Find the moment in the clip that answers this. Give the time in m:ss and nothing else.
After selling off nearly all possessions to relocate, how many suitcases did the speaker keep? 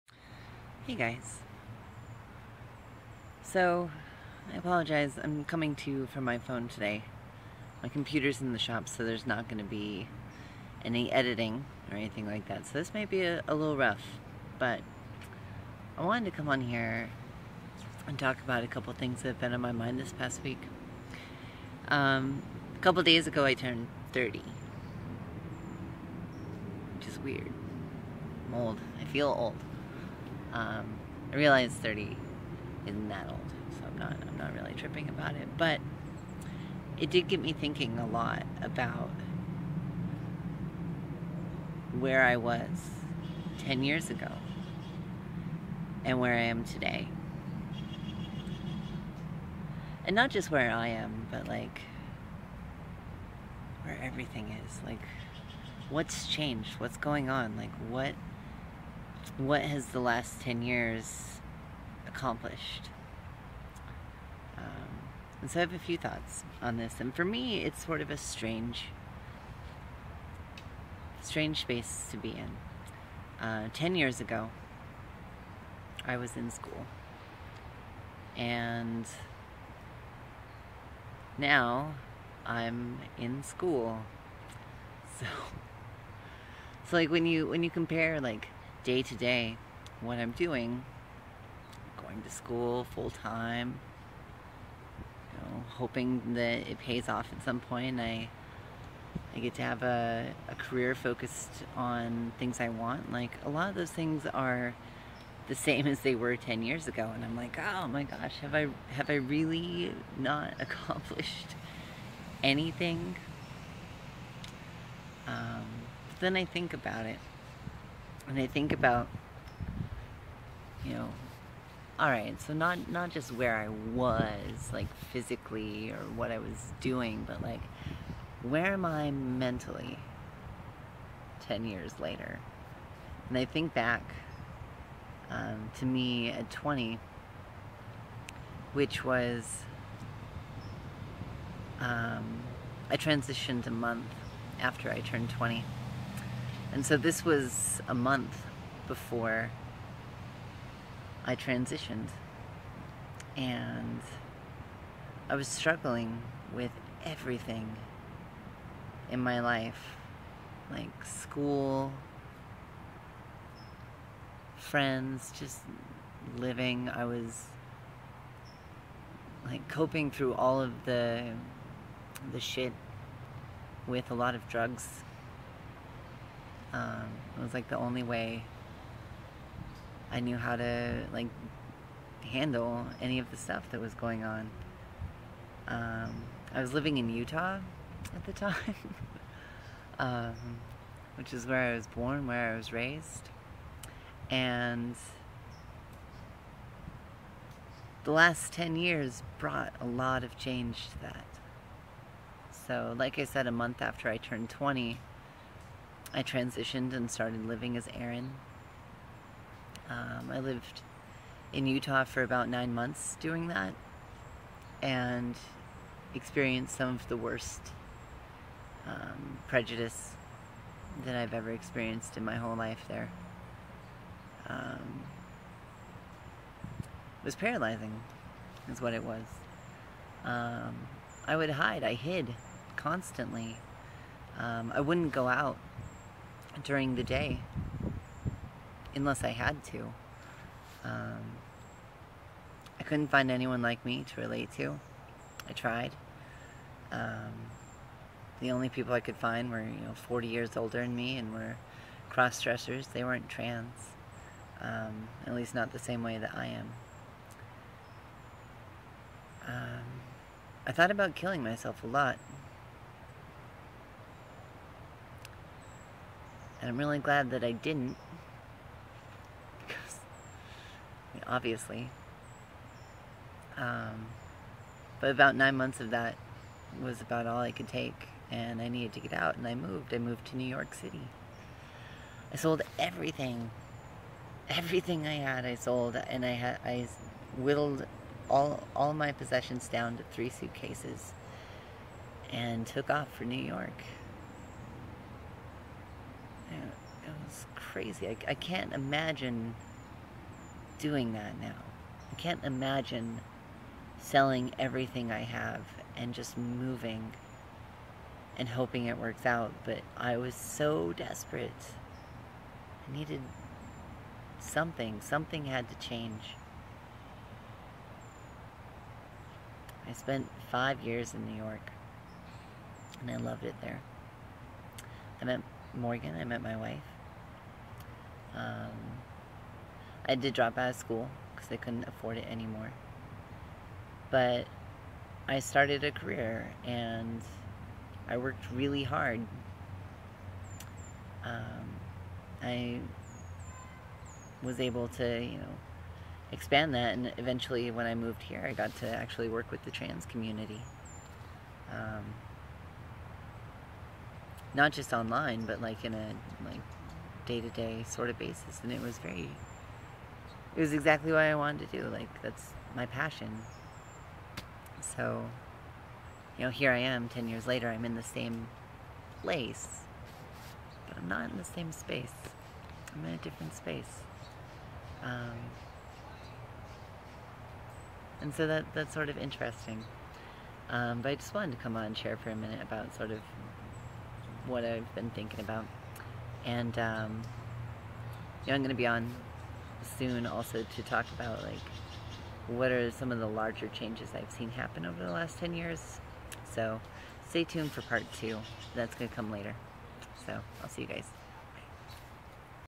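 4:50.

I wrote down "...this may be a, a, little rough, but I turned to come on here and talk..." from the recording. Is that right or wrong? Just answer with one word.
wrong.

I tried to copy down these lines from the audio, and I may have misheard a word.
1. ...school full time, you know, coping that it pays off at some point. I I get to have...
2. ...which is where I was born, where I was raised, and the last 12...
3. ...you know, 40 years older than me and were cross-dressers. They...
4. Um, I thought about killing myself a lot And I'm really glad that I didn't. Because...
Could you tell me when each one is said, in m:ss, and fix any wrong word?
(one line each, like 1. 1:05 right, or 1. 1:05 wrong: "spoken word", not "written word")
1. 1:32 wrong: "hoping", not "coping"
2. 3:11 wrong: "10", not "12"
3. 4:09 right
4. 4:19 right.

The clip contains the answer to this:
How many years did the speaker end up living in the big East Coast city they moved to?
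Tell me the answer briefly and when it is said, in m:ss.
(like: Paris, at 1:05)
5 years, at 5:20.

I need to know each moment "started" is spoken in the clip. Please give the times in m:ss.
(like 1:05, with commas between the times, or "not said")
3:27, 5:35.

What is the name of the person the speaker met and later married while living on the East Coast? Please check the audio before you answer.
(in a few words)
Morgan.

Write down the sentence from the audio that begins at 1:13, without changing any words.
Uh, 10 years ago, I was in school.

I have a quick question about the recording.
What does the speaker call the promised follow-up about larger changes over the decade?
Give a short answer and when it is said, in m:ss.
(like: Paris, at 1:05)
Part two, at 6:37.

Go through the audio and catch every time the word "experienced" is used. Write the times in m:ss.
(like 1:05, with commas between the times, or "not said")
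3:36, 3:41.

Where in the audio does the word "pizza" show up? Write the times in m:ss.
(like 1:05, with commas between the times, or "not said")
not said.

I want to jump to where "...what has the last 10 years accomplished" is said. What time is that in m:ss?
0:59.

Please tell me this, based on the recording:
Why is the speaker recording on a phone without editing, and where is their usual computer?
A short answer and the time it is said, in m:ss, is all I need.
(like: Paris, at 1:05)
In the shop, at 0:08.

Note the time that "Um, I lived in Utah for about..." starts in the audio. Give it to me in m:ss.
3:29.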